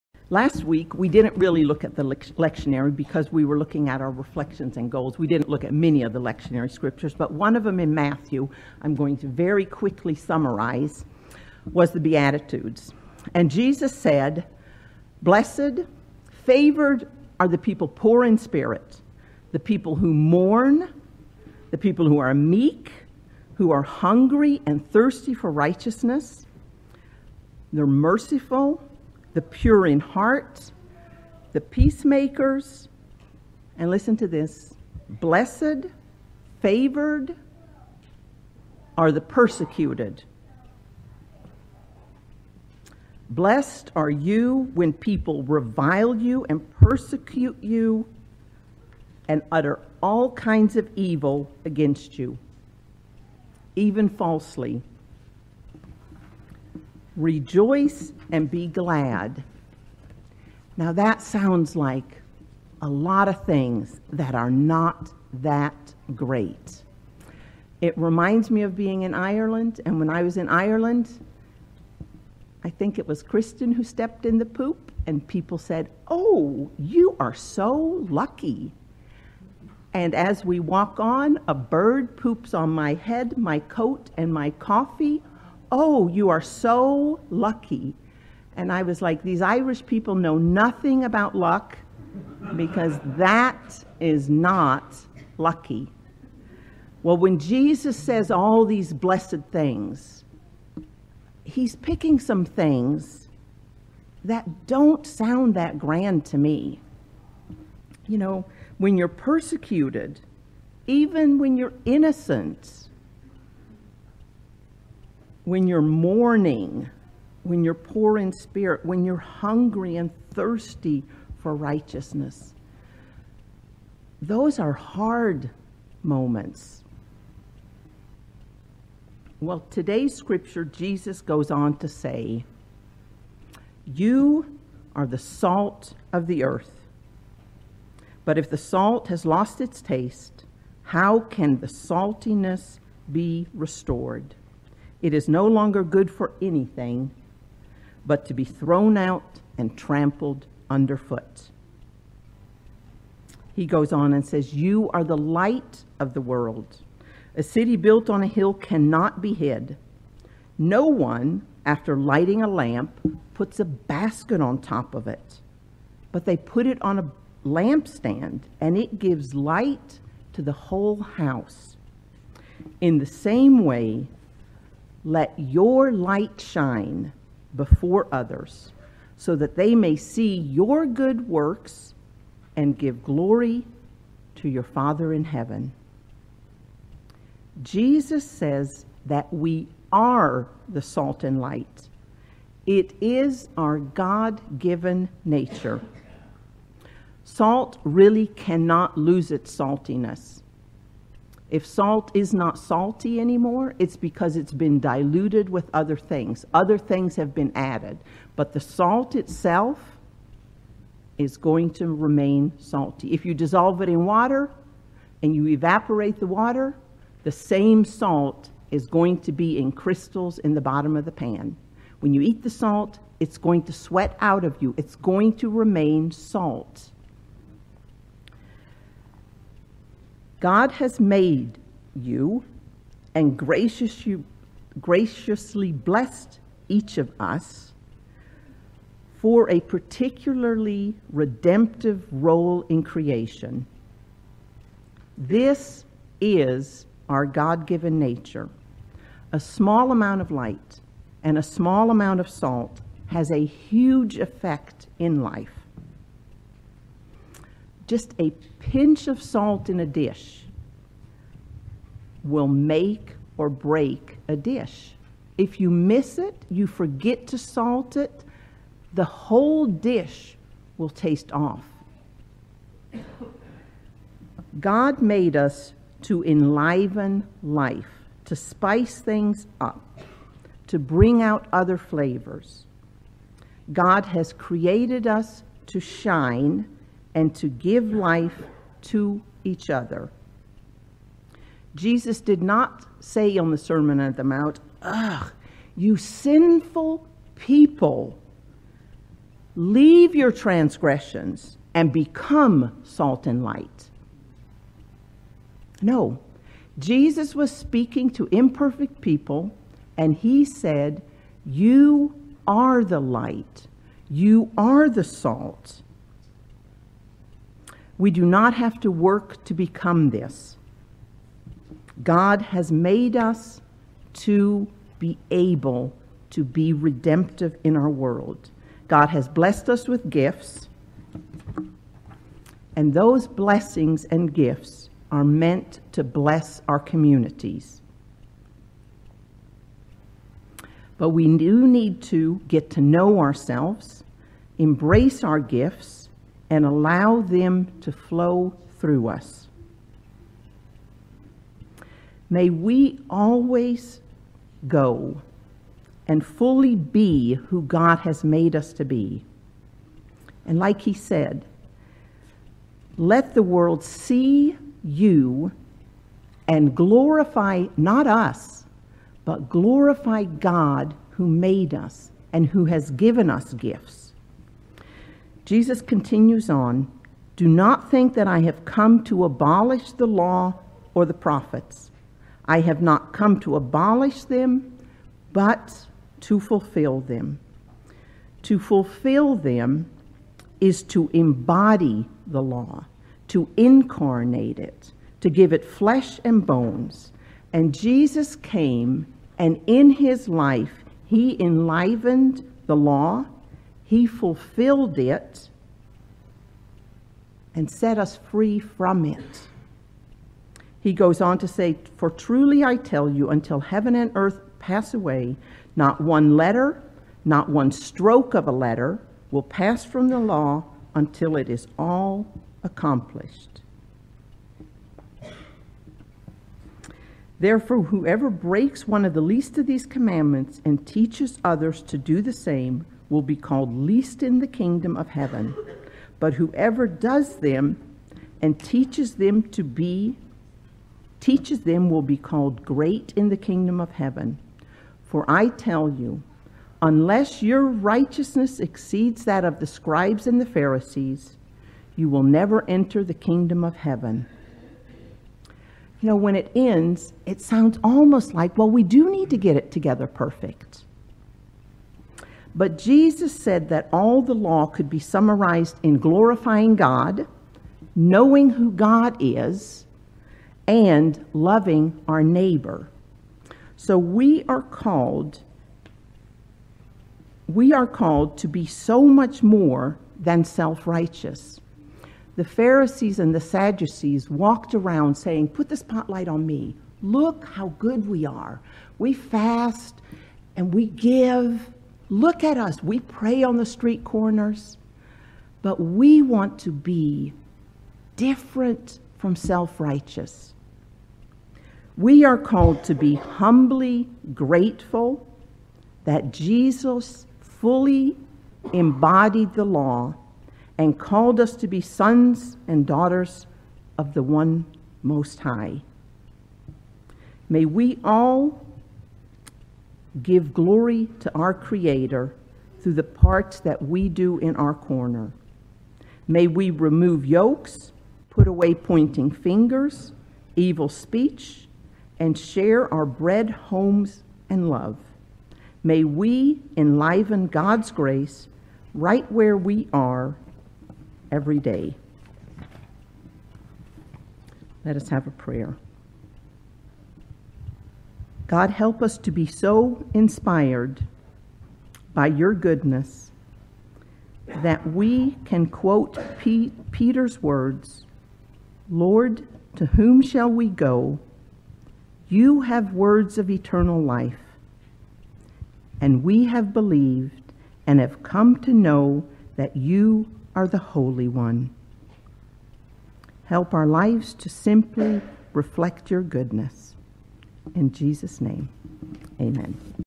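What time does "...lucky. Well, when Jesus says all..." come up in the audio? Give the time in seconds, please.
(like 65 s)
95 s.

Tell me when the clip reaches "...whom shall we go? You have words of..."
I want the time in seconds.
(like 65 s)
559 s.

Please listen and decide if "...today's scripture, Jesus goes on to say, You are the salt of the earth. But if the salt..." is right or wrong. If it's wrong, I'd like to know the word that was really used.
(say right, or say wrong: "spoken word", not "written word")
right.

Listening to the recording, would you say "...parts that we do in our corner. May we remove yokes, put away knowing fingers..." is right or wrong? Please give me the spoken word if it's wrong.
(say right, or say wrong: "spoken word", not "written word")
wrong: "pointing", not "knowing".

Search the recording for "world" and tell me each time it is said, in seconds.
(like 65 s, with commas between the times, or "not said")
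156 s, 327 s, 363 s.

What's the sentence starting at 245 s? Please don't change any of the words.
This is our God given nature.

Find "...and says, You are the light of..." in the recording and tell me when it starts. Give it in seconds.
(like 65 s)
154 s.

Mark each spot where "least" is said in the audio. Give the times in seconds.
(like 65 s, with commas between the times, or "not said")
429 s, 433 s.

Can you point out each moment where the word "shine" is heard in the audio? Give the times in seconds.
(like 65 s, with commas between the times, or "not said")
176 s, 285 s.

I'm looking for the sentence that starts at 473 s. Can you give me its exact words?
So we are called we are called to be so much more than self-righteous.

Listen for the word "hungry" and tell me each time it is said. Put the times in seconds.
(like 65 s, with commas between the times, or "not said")
23 s, 119 s.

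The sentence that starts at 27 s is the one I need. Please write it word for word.
They're merciful, the pure in heart, the peacemakers, and listen to this blessed, favored are the persecuted.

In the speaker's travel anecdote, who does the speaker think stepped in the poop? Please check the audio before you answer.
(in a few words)
Kristen.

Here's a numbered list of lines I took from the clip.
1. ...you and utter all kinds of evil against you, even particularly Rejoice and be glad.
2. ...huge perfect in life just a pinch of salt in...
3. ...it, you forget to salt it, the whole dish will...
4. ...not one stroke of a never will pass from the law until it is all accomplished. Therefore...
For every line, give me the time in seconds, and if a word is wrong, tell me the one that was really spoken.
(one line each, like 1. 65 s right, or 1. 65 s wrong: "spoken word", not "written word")
1. 47 s wrong: "falsely", not "particularly"
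2. 253 s wrong: "effect", not "perfect"
3. 266 s right
4. 417 s wrong: "letter", not "never".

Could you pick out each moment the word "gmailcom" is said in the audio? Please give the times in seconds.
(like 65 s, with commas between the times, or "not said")
not said.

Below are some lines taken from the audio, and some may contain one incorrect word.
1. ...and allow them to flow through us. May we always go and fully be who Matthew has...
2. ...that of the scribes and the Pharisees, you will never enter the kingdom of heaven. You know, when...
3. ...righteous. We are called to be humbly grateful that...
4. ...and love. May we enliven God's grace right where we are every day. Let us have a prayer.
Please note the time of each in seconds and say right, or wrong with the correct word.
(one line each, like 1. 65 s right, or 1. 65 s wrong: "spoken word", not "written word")
1. 346 s wrong: "God", not "Matthew"
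2. 449 s right
3. 499 s right
4. 534 s right.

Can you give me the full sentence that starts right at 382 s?
I have not come to abolish them, but to fulfill them.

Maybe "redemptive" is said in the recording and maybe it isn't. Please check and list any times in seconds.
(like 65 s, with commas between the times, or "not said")
241 s, 326 s.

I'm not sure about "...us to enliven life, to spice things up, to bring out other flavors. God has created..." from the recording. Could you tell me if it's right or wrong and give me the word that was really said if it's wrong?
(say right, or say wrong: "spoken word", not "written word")
right.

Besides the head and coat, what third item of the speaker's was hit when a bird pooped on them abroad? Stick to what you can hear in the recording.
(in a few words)
Coffee.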